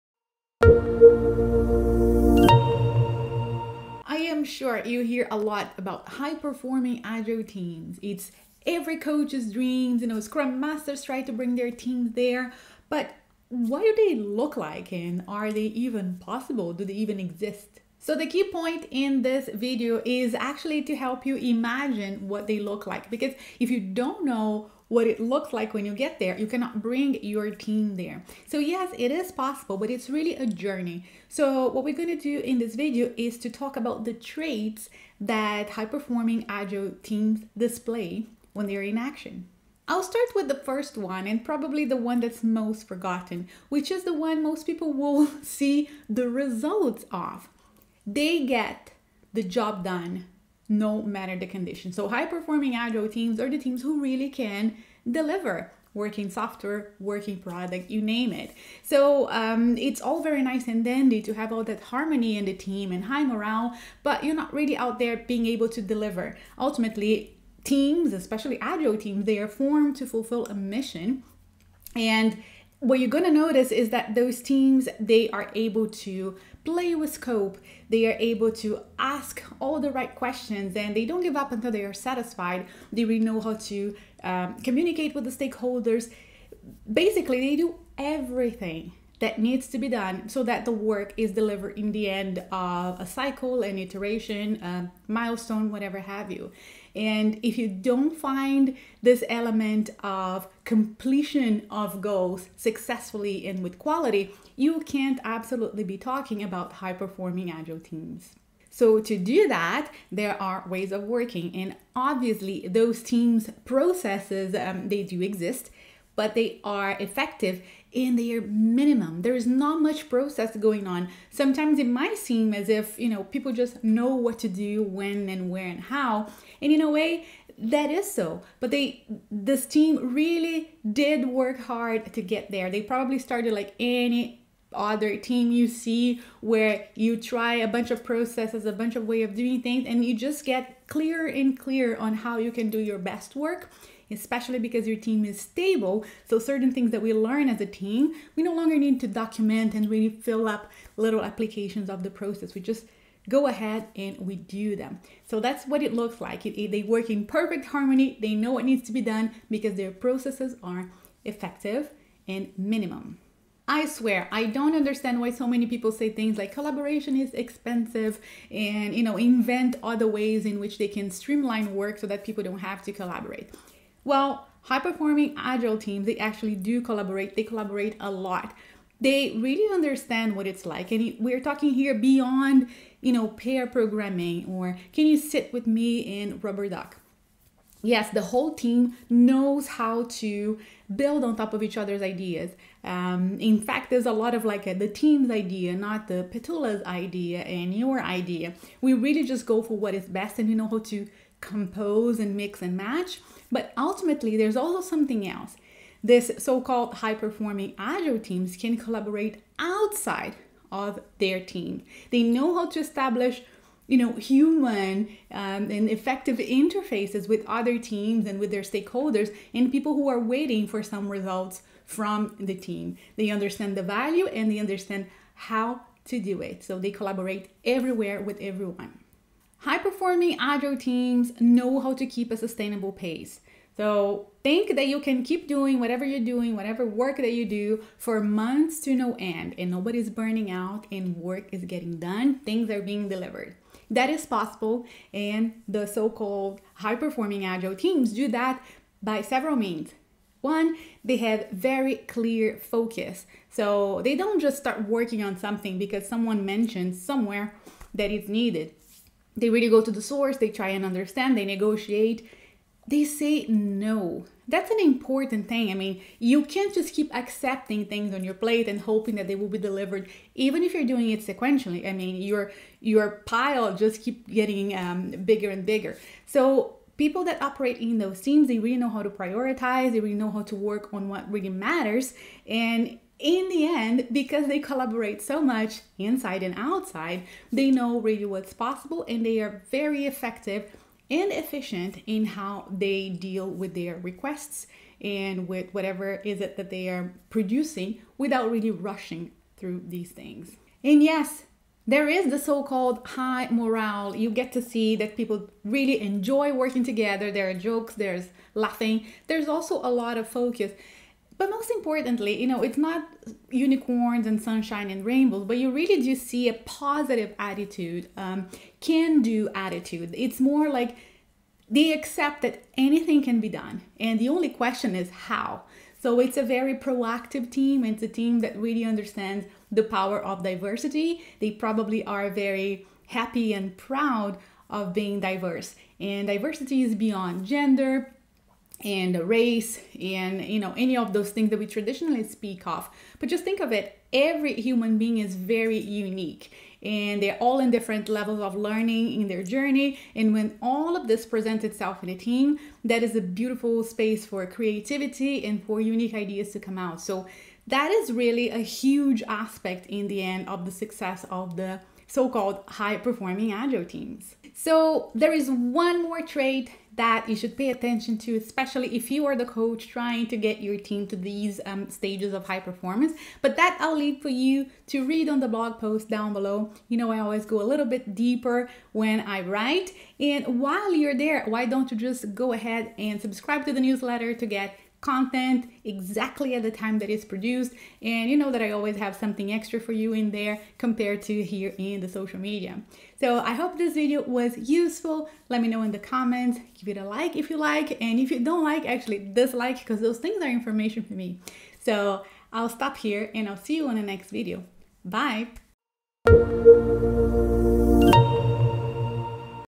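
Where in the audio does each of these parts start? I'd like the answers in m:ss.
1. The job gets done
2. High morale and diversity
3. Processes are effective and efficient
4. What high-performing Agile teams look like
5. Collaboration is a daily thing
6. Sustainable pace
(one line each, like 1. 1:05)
1. 0:40
2. 5:01
3. 1:49
4. 0:18
5. 2:43
6. 3:49.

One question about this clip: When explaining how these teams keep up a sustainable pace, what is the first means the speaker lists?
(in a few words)
Very clear focus.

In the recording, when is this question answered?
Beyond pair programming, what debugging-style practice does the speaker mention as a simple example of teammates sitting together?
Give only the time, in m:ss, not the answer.
3:06.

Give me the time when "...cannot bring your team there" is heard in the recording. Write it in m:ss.
0:26.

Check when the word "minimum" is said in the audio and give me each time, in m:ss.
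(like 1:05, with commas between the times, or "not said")
1:58, 2:42.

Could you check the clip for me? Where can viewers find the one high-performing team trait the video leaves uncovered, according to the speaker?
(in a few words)
The blog post.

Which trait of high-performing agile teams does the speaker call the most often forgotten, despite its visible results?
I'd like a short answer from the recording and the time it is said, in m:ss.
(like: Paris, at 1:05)
They get the job done, at 0:48.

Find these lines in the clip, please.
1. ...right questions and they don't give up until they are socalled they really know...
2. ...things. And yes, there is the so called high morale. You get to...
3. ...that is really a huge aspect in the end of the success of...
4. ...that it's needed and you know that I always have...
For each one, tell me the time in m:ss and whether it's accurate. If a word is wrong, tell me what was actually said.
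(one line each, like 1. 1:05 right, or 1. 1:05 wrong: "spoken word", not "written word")
1. 1:19 wrong: "satisfied", not "socalled"
2. 5:00 right
3. 5:57 right
4. 6:26 wrong: "produced", not "needed".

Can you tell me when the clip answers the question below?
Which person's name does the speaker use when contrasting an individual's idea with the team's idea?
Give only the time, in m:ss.
3:16.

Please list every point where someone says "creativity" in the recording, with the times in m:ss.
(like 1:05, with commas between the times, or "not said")
5:54.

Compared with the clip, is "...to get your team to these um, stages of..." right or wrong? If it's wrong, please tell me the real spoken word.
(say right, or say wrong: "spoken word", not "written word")
right.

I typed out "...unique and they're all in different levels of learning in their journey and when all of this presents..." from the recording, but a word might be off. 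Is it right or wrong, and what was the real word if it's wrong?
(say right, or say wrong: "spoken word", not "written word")
right.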